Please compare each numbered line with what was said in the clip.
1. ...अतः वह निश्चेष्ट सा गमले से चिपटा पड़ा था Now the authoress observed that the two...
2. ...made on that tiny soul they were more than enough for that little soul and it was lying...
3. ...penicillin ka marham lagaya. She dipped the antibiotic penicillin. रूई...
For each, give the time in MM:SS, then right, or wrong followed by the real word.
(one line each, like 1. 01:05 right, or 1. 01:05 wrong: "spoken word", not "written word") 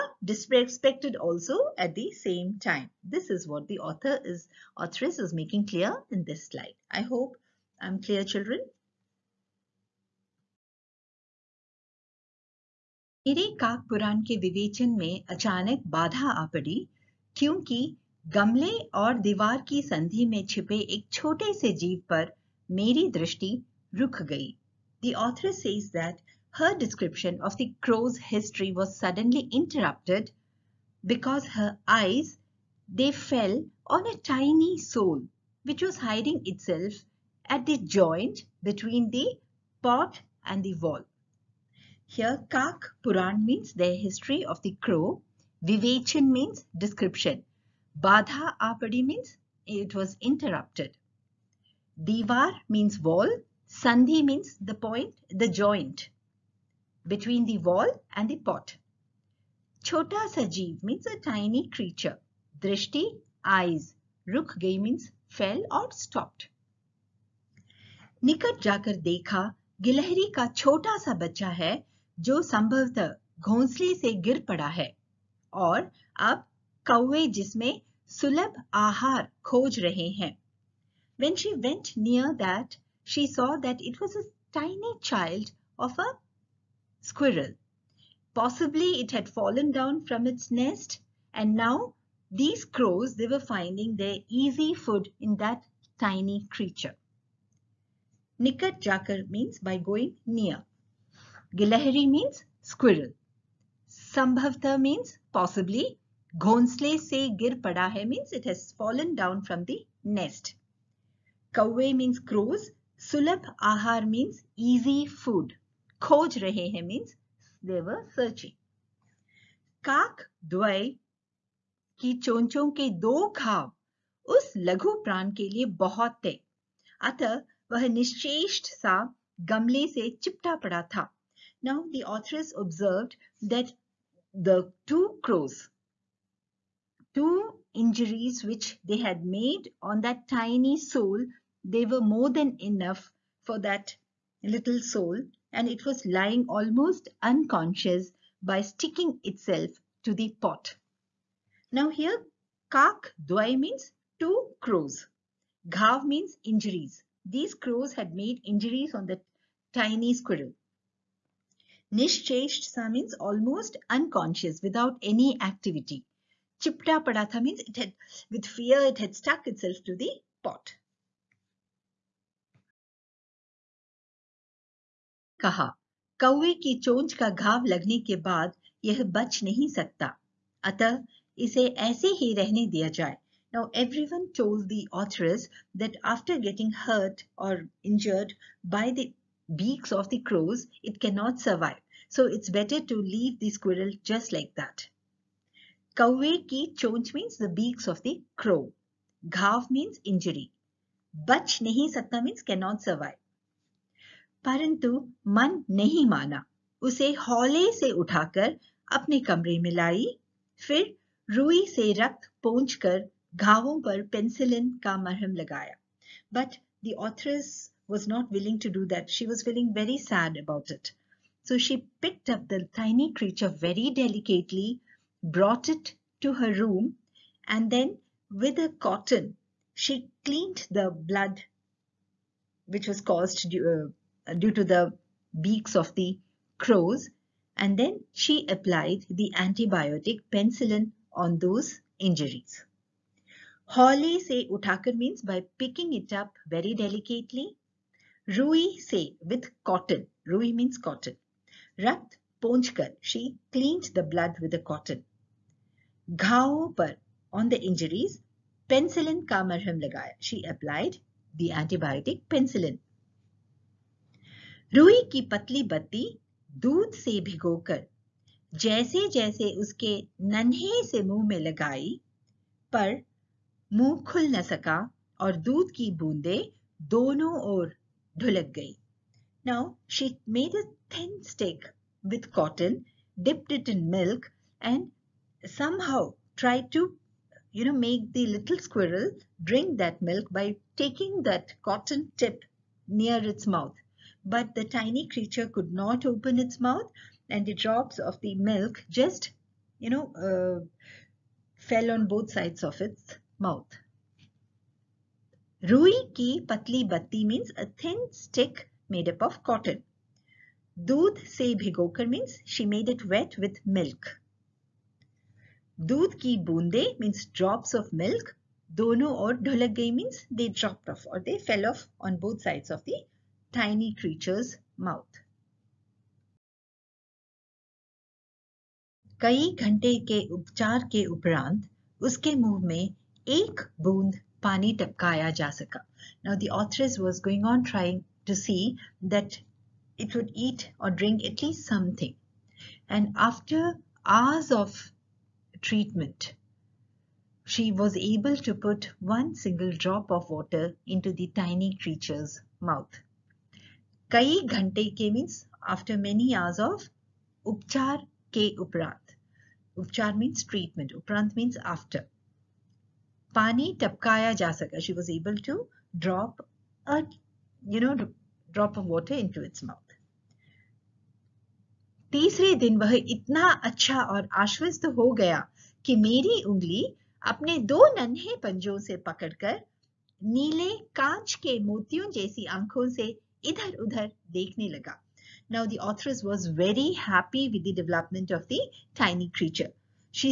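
1. 02:07 right
2. 02:19 right
3. 04:18 wrong: "applied", not "dipped".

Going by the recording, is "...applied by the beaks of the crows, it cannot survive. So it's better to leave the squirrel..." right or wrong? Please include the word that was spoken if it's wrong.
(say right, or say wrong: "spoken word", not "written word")
wrong: "injured", not "applied".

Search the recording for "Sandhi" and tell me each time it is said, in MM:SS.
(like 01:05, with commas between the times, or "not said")
00:53.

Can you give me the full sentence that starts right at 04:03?
Holly se utakar means by picking it up very delicately Rui se with cotton.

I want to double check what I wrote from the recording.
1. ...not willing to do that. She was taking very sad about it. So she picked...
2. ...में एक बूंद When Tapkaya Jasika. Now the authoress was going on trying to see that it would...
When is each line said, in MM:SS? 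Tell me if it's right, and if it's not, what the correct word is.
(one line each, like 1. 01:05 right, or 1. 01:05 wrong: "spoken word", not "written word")
1. 03:38 wrong: "feeling", not "taking"
2. 05:32 wrong: "Pani", not "When".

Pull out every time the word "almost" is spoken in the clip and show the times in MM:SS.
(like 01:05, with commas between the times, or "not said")
02:26, 02:43.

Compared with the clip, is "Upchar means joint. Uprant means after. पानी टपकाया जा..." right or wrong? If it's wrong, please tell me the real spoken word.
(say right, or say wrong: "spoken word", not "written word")
wrong: "treatment", not "joint".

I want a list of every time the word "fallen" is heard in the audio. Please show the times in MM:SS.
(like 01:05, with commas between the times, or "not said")
01:29, 01:48.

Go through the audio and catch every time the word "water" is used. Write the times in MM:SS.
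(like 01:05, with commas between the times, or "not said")
05:50.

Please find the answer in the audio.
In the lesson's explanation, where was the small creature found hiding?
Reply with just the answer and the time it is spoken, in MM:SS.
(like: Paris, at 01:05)
Between the pot and the wall, at 00:37.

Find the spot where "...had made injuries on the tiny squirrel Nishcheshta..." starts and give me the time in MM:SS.
02:37.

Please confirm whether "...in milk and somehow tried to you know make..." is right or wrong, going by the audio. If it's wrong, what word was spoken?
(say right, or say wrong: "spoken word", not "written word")
right.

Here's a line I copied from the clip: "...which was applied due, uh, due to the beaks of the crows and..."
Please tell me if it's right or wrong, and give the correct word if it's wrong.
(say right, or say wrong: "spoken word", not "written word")
wrong: "caused", not "applied".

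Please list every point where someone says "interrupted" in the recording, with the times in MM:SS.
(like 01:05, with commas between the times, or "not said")
00:29, 00:50.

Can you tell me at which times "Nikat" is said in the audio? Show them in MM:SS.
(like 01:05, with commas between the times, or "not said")
01:08, 01:38.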